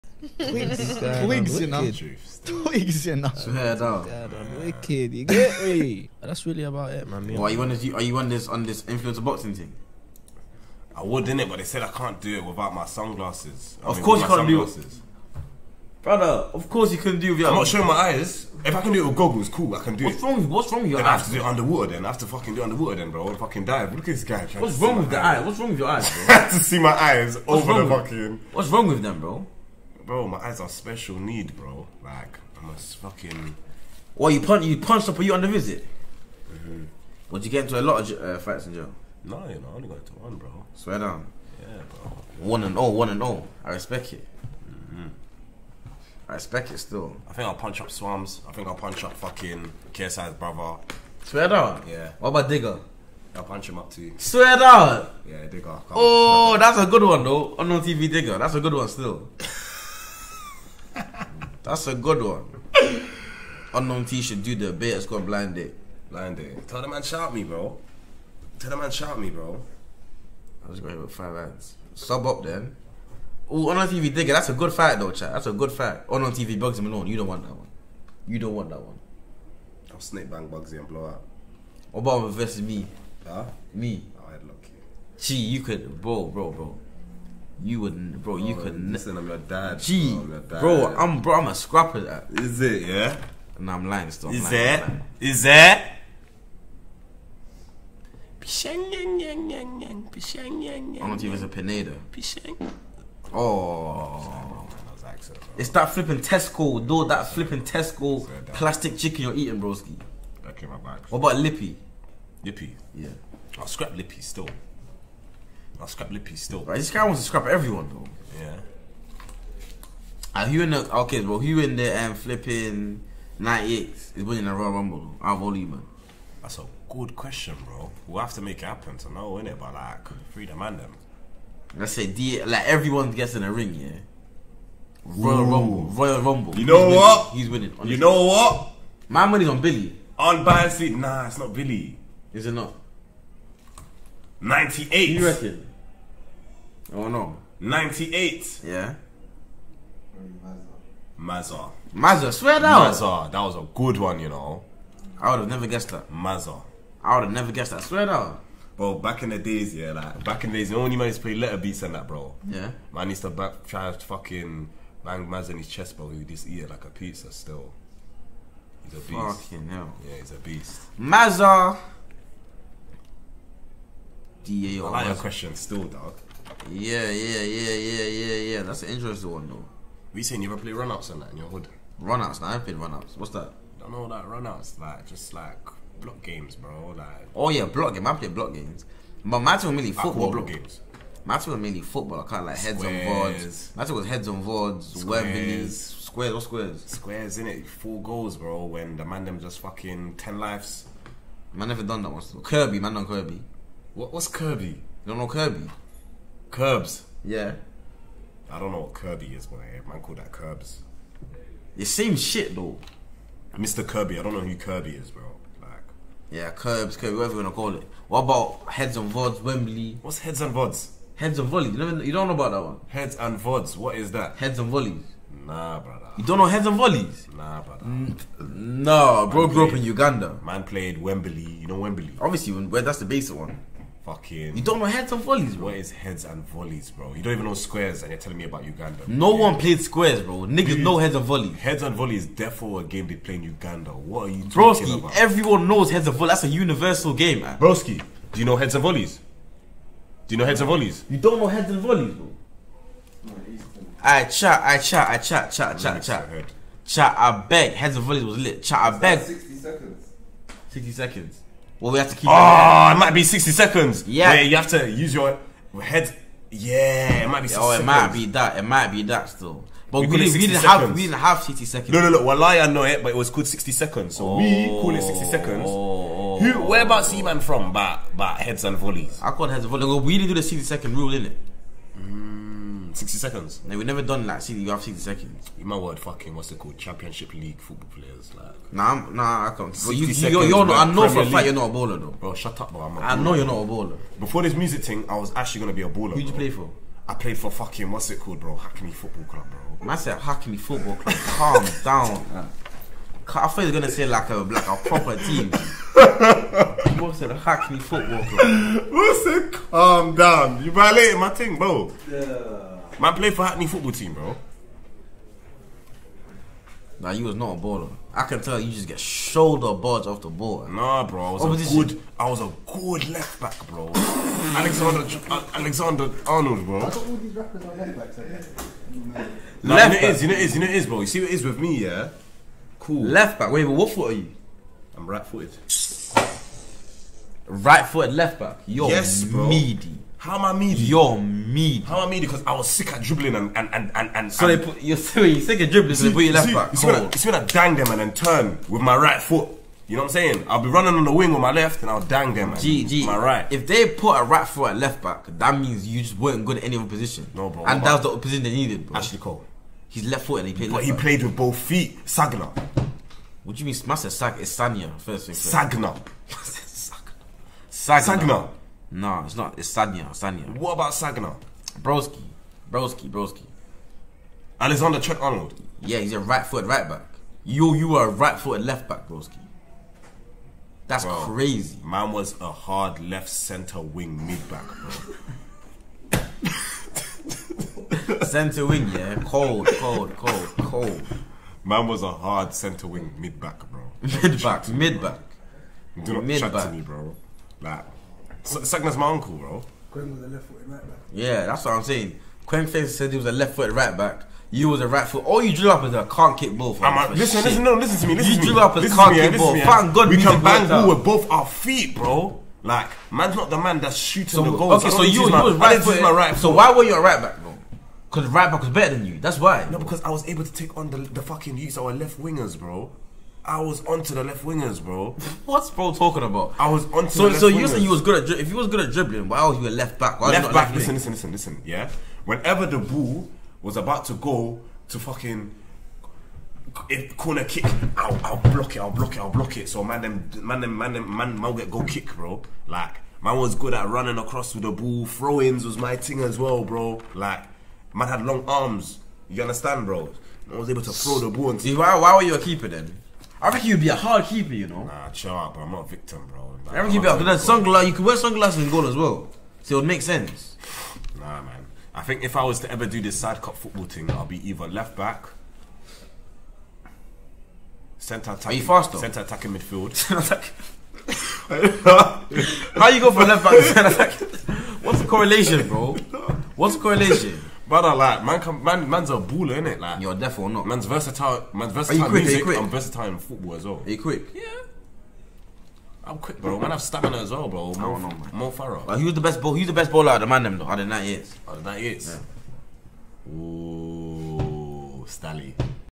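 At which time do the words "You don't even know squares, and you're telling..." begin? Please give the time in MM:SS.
03:57.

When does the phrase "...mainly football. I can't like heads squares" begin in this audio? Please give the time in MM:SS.
03:11.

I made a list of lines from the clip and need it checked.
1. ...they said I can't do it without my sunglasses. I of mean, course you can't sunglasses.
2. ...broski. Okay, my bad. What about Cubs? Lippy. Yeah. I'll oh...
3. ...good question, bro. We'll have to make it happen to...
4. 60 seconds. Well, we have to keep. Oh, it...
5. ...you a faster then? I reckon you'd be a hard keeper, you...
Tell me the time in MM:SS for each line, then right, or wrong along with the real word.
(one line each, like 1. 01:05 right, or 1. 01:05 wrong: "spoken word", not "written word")
1. 00:11 right
2. 01:49 wrong: "Lippy", not "Cubs"
3. 02:06 right
4. 04:20 right
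5. 07:32 wrong: "keeper", not "faster".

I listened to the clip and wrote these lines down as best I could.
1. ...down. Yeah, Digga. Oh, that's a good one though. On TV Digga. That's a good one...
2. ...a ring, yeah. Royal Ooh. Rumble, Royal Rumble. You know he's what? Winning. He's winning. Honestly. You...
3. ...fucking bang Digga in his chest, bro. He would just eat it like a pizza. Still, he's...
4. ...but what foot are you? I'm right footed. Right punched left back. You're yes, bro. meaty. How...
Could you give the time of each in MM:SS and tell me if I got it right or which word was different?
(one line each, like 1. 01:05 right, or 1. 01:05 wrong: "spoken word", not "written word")
1. 00:54 right
2. 02:13 right
3. 02:43 wrong: "Mazza", not "Digga"
4. 05:33 wrong: "footed", not "punched".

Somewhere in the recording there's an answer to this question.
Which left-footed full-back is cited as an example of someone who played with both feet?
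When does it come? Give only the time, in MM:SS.
05:58.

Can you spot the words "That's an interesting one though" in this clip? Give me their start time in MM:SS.
02:58.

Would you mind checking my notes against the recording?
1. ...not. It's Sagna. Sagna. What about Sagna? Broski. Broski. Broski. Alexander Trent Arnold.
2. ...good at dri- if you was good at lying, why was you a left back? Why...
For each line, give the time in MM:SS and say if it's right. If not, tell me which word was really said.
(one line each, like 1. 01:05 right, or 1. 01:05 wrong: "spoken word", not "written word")
1. 06:09 right
2. 07:08 wrong: "dribbling", not "lying".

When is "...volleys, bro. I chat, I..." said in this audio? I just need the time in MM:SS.
04:11.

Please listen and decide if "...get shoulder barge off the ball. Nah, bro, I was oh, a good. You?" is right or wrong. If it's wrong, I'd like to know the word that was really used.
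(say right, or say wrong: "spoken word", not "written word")
right.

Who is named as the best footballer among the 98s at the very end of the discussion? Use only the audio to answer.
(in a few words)
Stally.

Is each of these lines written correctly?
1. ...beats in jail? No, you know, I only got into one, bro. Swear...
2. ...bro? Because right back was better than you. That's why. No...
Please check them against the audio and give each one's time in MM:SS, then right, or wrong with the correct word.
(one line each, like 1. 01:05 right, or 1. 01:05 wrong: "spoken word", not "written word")
1. 00:38 wrong: "fights", not "beats"
2. 06:57 right.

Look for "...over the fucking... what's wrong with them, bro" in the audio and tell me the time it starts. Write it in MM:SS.
00:27.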